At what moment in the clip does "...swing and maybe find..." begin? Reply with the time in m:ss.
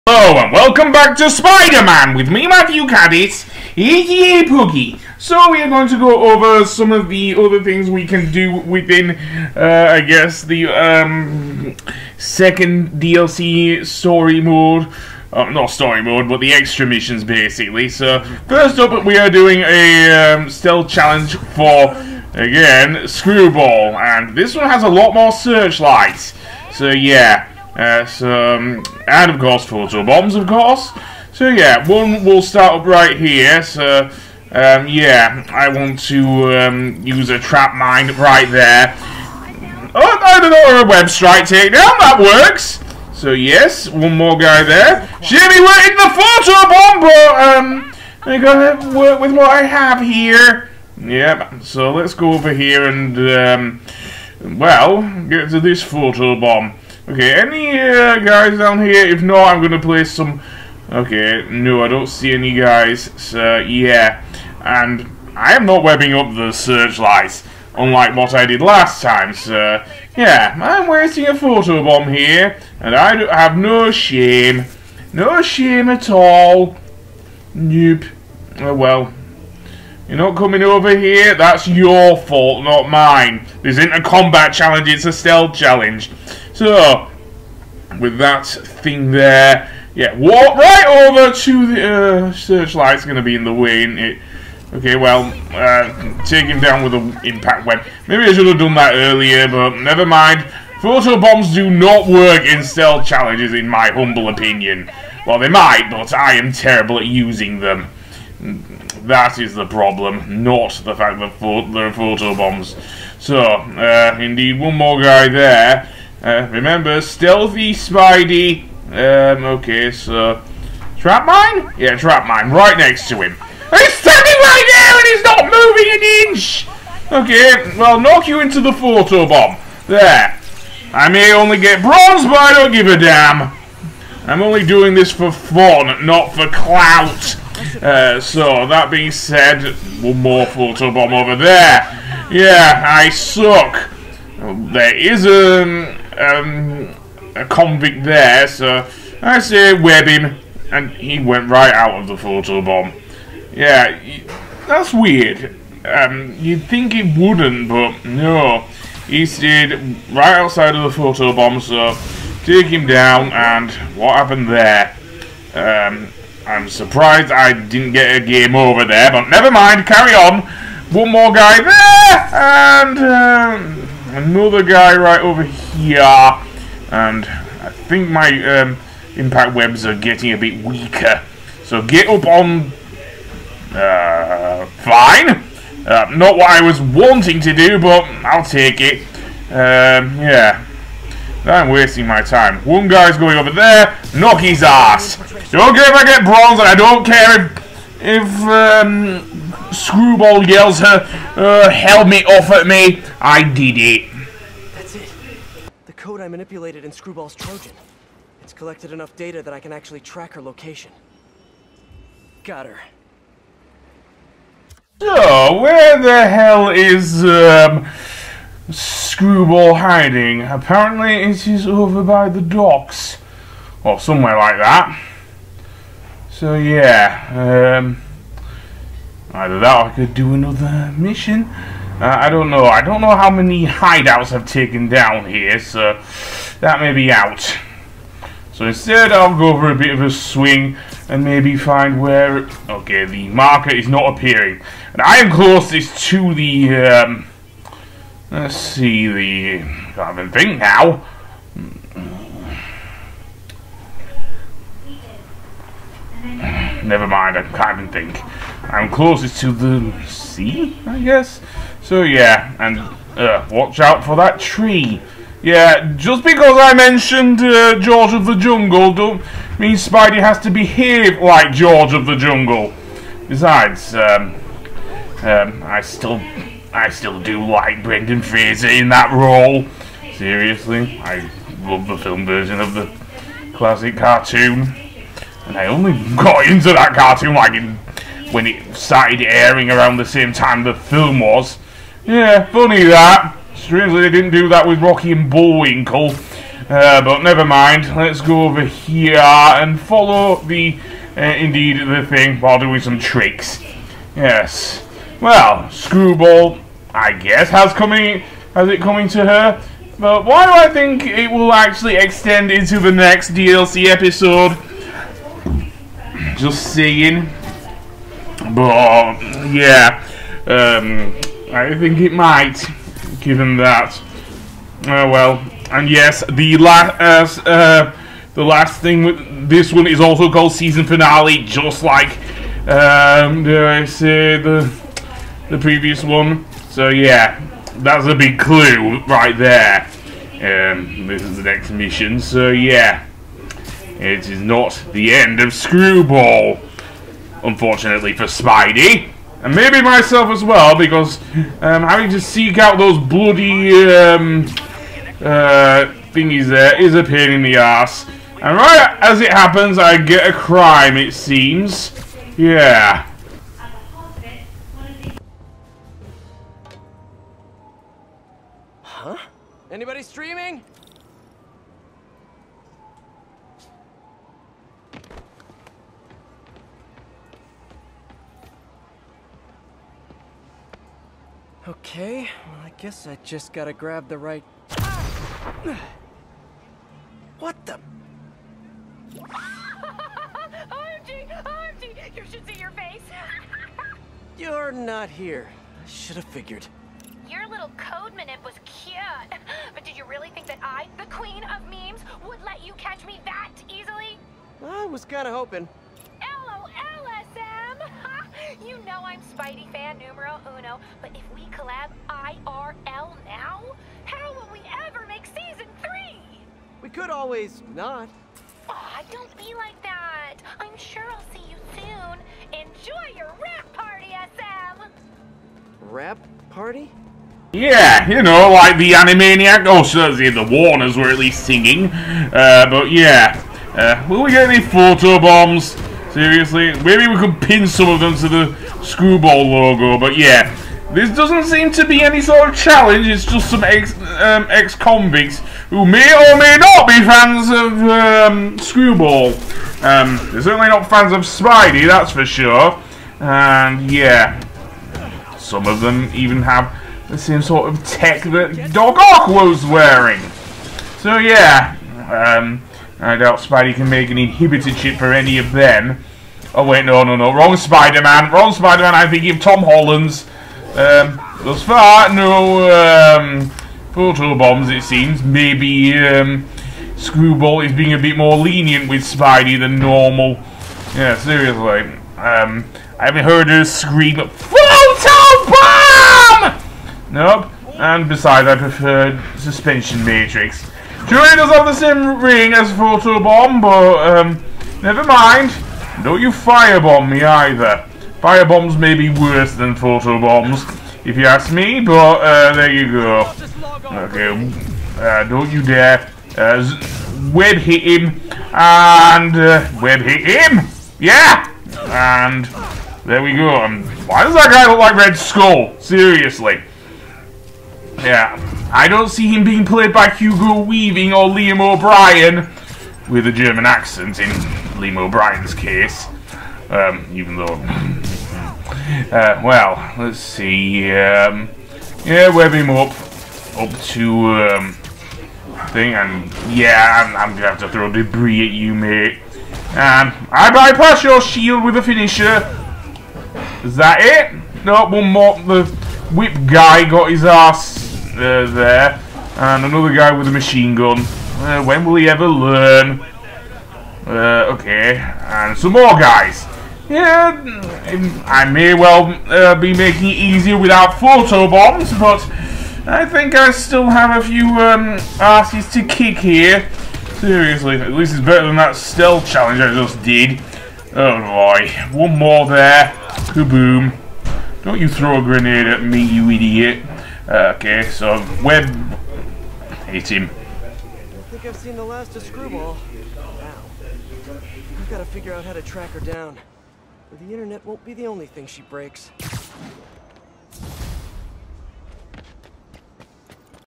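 4:00.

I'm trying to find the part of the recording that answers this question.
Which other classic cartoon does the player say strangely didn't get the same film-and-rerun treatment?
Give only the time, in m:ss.
4:54.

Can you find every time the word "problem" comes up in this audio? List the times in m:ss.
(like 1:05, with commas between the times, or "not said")
1:49.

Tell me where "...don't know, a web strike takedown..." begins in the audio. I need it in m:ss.
0:40.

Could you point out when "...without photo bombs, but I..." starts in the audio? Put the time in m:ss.
9:20.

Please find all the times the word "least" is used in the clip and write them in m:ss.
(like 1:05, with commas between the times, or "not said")
7:11, 9:27.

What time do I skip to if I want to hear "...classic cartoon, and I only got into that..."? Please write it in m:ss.
4:43.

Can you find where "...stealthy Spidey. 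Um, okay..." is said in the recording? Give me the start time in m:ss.
1:57.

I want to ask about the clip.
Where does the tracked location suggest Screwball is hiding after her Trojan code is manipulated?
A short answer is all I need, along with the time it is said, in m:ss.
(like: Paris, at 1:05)
the docks, at 3:42.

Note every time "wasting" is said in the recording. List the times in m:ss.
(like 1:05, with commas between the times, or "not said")
1:10, 3:11.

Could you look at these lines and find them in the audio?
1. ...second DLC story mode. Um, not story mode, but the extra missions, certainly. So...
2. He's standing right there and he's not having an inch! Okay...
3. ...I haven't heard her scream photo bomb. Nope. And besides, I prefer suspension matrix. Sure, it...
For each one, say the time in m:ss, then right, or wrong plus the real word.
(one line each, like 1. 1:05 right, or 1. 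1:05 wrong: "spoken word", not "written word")
1. 0:12 wrong: "basically", not "certainly"
2. 2:03 wrong: "moving", not "having"
3. 8:02 right.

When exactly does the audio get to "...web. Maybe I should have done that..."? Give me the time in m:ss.
1:37.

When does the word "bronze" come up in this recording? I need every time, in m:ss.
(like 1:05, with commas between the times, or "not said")
2:11, 3:16.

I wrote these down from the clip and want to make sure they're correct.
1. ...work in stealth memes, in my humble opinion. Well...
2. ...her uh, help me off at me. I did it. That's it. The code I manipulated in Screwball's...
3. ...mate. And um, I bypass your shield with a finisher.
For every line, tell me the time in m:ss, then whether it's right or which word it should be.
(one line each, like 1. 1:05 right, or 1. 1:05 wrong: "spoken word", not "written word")
1. 1:42 wrong: "challenges", not "memes"
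2. 3:20 right
3. 8:58 right.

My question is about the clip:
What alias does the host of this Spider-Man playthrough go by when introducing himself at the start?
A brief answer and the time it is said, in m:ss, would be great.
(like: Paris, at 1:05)
Puggy, at 0:04.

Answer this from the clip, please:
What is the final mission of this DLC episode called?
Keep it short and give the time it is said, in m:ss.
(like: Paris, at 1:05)
Season Finale, at 5:30.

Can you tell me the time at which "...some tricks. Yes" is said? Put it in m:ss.
5:02.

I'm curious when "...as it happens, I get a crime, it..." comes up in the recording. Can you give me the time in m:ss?
5:59.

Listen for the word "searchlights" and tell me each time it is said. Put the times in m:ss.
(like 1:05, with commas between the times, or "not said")
0:25, 1:06, 1:32.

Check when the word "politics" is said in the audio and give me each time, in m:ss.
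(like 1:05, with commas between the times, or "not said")
not said.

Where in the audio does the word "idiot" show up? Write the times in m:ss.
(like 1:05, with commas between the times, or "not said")
9:36.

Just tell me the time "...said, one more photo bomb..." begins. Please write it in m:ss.
2:19.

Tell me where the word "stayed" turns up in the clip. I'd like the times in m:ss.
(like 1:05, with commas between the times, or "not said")
2:39.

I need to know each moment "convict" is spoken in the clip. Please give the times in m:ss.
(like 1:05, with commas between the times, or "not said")
2:27, 7:24.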